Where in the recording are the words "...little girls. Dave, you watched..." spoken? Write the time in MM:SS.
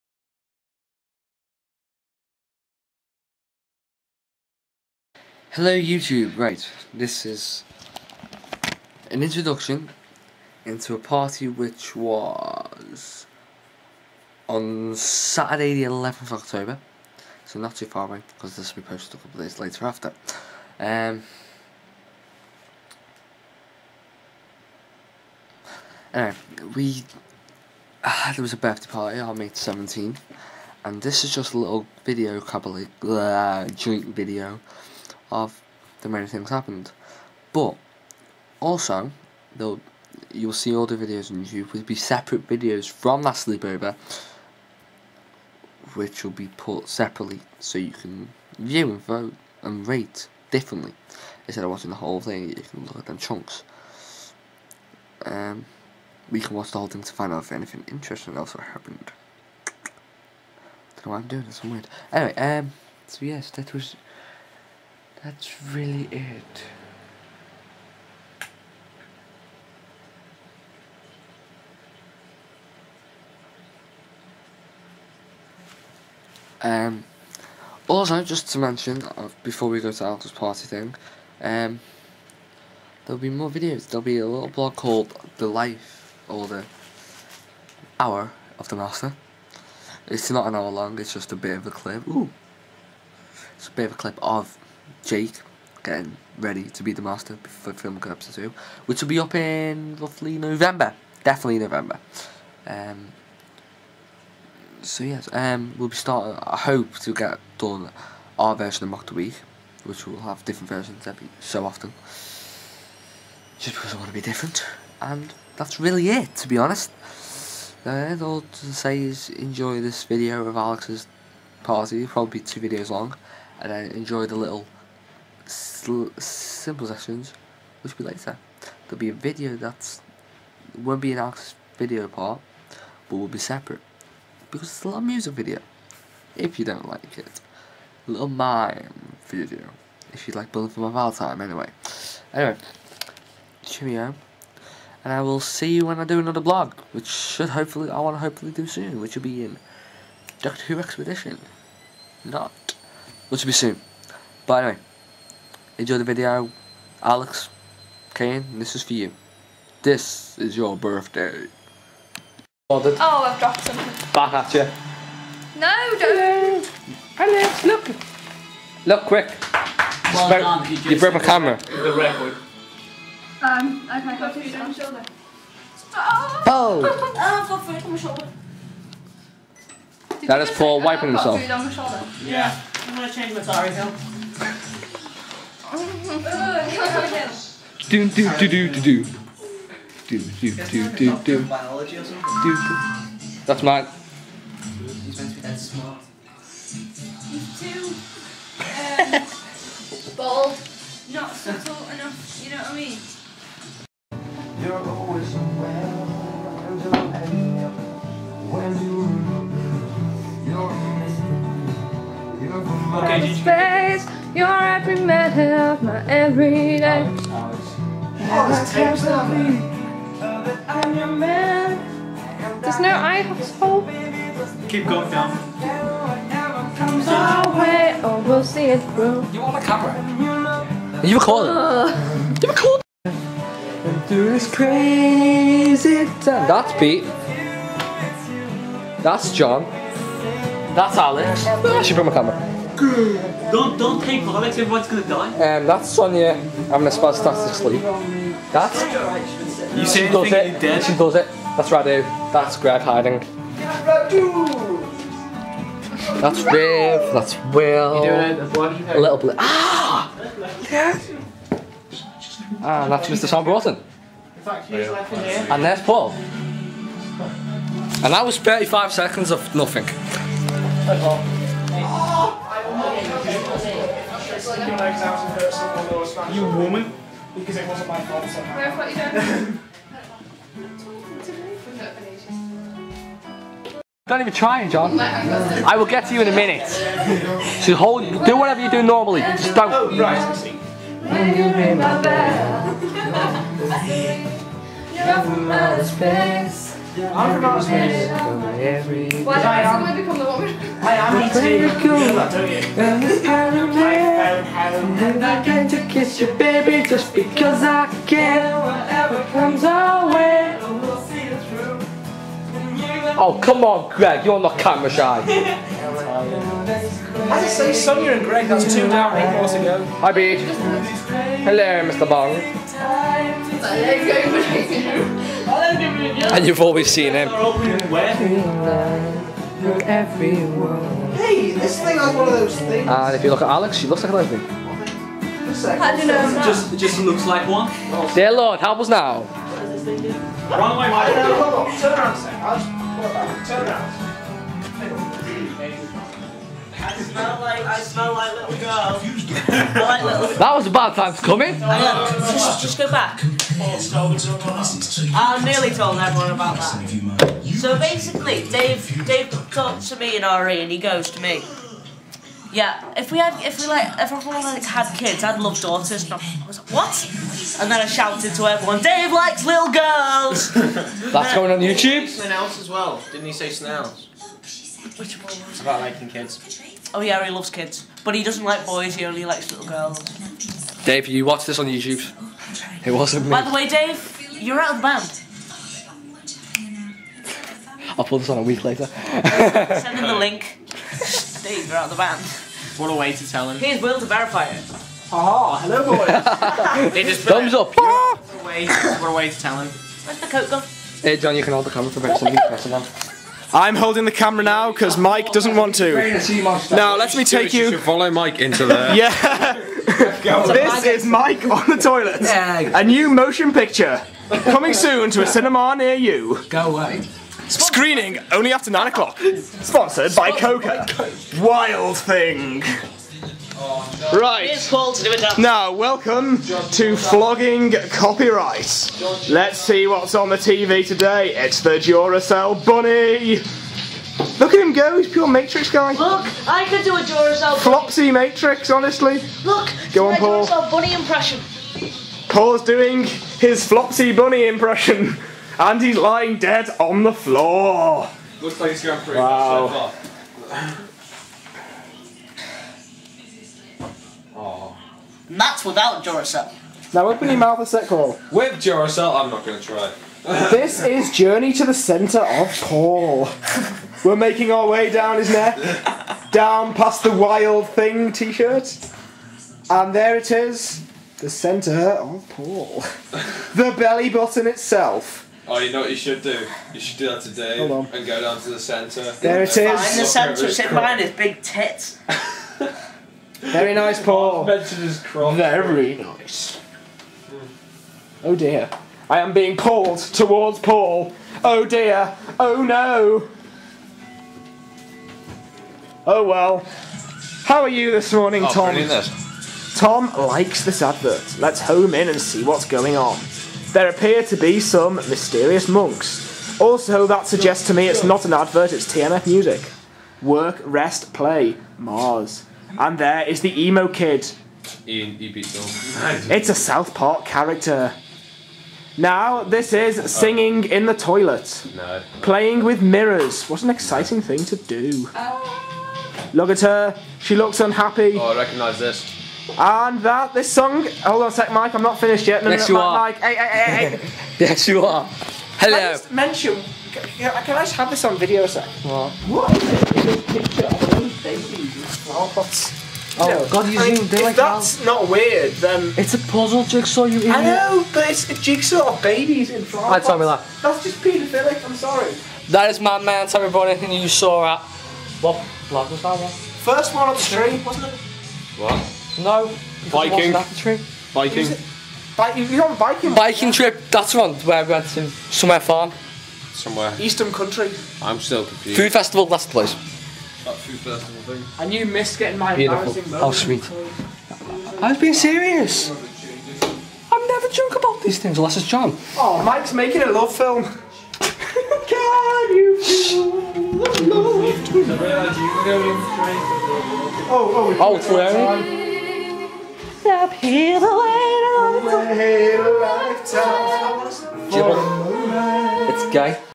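06:19.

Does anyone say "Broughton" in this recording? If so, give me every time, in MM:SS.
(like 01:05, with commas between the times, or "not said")
04:23.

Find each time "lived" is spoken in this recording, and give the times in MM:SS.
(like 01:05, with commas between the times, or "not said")
not said.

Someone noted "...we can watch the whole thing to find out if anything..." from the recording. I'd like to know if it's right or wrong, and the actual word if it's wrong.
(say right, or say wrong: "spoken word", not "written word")
right.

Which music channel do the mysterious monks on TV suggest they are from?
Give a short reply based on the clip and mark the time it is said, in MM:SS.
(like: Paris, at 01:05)
TMF, at 08:28.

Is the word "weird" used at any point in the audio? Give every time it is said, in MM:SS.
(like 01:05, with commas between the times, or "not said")
01:01, 09:05.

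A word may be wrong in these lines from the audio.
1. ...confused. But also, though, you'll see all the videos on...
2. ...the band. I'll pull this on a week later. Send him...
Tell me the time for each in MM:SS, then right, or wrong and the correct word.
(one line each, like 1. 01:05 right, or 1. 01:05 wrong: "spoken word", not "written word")
1. 00:36 wrong: "happened", not "confused"
2. 06:24 right.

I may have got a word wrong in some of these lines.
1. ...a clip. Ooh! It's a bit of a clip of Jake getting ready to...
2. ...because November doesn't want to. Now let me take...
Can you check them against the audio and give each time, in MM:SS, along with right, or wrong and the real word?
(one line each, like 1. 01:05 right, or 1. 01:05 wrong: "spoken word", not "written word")
1. 01:31 right
2. 06:44 wrong: "Mike", not "November".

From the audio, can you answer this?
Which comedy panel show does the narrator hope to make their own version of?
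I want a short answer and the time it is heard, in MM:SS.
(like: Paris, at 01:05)
Mock the Week, at 01:48.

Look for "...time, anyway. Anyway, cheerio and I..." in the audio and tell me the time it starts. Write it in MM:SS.
02:21.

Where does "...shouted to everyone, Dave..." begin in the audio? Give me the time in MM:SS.
06:07.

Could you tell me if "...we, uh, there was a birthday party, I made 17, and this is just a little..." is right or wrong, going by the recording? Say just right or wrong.
right.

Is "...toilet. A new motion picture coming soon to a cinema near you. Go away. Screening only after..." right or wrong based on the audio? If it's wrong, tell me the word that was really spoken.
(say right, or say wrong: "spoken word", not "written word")
right.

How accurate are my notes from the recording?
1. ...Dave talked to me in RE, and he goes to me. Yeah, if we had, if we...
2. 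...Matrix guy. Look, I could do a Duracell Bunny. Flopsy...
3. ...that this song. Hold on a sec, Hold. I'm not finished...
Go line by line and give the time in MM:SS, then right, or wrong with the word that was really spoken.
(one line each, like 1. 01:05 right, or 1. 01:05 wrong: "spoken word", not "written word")
1. 05:59 right
2. 07:15 right
3. 08:50 wrong: "Mike", not "Hold".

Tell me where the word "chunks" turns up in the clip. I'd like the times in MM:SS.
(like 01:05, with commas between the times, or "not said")
00:53.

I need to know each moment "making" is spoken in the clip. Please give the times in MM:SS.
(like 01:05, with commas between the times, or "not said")
07:44, 09:39.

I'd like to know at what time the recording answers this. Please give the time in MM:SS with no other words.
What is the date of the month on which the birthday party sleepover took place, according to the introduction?
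00:15.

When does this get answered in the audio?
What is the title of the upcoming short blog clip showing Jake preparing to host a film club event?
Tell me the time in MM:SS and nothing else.
01:26.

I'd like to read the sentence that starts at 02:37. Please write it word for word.
Alex, Kane, this is for you.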